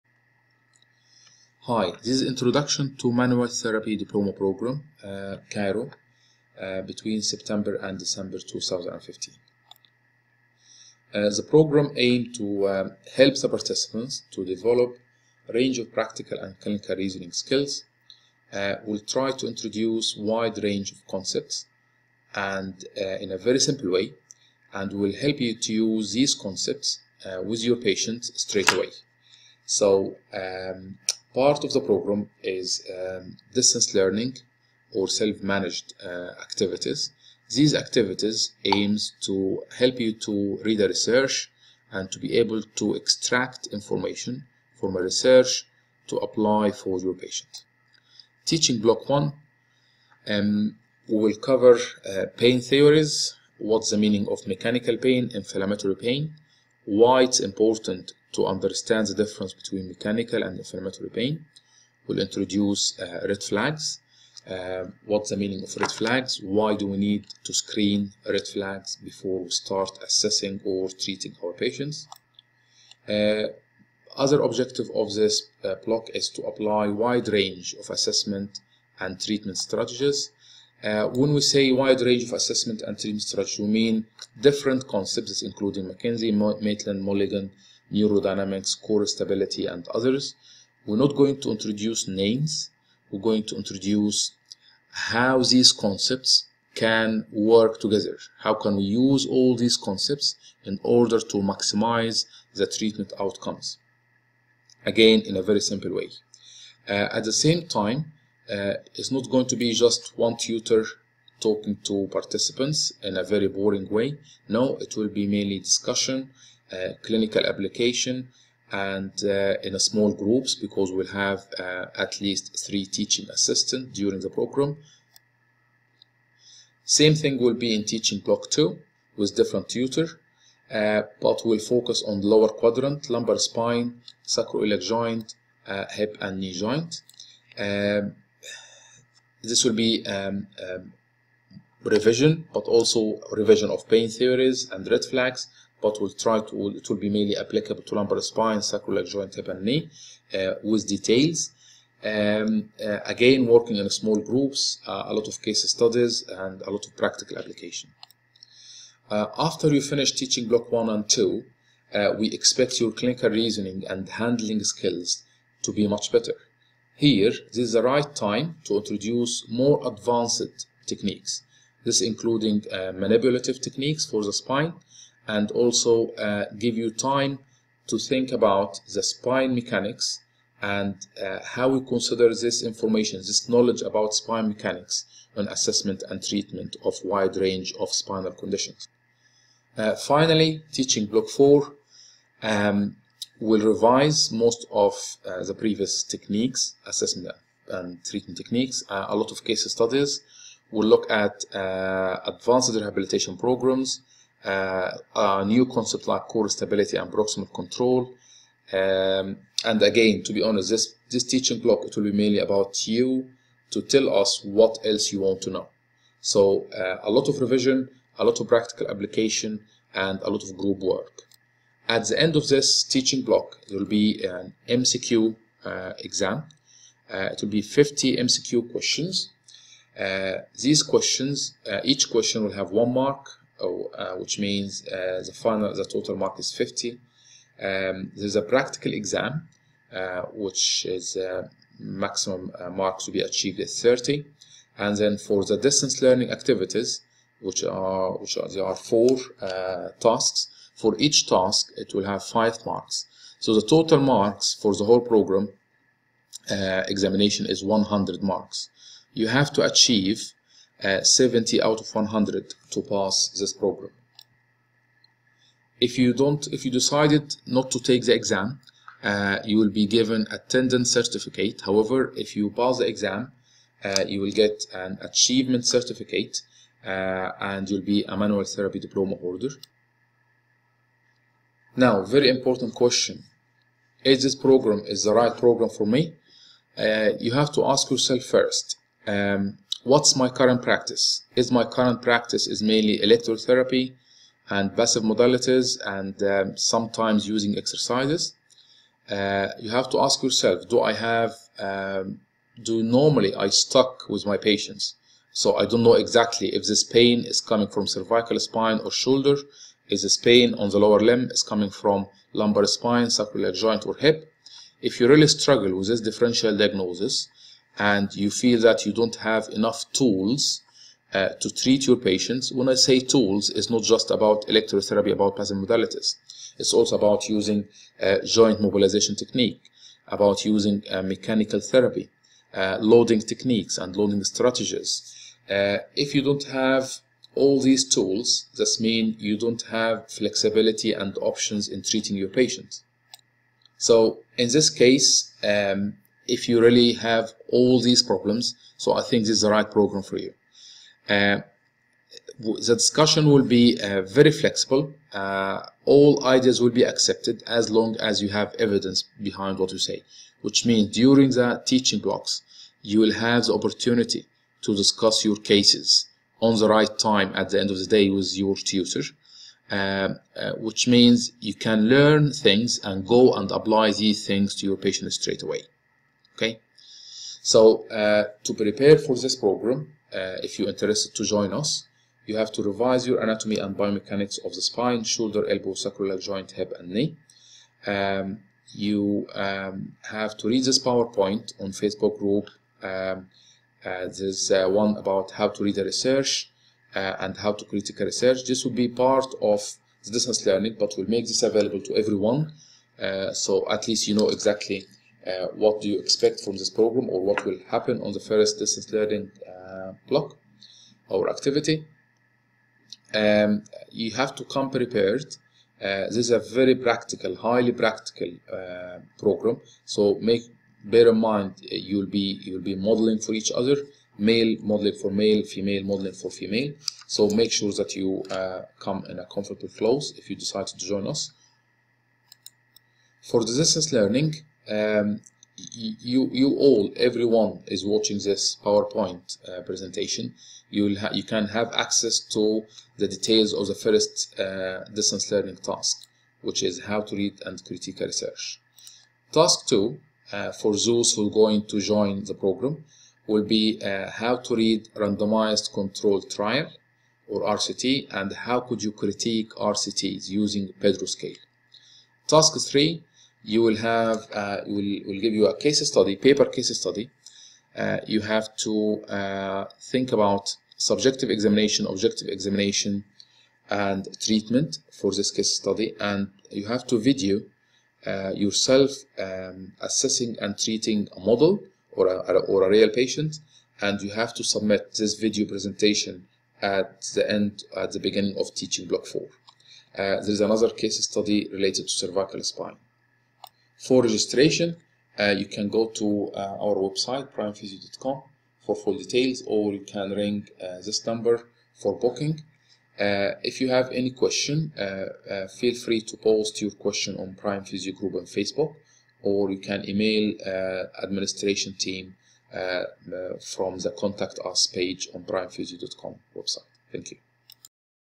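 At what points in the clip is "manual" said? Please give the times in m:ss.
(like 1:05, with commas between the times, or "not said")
0:03, 4:38.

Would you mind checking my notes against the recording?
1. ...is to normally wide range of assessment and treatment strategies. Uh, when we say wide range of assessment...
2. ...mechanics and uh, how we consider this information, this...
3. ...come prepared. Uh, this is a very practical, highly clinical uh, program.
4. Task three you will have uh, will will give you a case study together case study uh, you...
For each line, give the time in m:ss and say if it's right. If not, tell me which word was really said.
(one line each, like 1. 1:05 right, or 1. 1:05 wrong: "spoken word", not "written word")
1. 1:16 wrong: "apply", not "normally"
2. 2:59 right
3. 6:54 wrong: "practical", not "clinical"
4. 7:42 wrong: "paper", not "together".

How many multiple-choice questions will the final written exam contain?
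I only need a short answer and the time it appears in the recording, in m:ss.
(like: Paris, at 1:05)
50, at 3:47.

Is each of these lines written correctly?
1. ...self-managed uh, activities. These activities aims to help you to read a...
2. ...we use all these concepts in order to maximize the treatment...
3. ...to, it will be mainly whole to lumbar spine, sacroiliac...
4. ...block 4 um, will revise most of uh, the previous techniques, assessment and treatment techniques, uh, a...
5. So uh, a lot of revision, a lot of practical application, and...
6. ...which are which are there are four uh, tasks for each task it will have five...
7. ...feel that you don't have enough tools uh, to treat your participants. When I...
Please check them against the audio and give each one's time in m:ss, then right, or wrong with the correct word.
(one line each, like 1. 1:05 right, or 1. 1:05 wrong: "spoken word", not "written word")
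1. 0:35 right
2. 1:38 right
3. 2:26 wrong: "applicable", not "whole"
4. 3:11 right
5. 3:36 right
6. 4:07 right
7. 5:18 wrong: "patients", not "participants".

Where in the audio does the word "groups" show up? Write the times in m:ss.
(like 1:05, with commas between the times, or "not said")
2:00, 2:34, 3:40, 6:32, 8:27.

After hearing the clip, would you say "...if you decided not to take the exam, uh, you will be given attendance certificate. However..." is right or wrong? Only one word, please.
right.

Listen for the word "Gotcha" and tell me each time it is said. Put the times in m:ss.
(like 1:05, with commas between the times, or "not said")
not said.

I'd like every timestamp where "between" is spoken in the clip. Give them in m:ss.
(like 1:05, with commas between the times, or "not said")
0:06, 0:59.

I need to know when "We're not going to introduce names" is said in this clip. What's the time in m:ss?
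1:30.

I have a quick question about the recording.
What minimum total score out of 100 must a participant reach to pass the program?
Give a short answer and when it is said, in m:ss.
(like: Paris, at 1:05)
70, at 4:21.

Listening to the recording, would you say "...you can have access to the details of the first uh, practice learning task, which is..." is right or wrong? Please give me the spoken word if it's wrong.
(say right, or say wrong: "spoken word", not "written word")
wrong: "distance", not "practice".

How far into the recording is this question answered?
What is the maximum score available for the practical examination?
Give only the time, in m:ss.
4:03.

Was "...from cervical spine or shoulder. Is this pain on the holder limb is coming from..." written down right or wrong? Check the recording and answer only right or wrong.
wrong.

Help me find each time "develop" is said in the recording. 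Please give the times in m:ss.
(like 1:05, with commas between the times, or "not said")
0:14.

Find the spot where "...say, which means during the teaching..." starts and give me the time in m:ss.
5:59.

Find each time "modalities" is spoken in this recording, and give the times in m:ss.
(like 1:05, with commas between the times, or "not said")
4:55, 5:25.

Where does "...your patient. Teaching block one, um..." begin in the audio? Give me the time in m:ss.
0:46.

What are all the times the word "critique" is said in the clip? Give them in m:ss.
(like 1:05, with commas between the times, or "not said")
6:37, 7:27, 7:38.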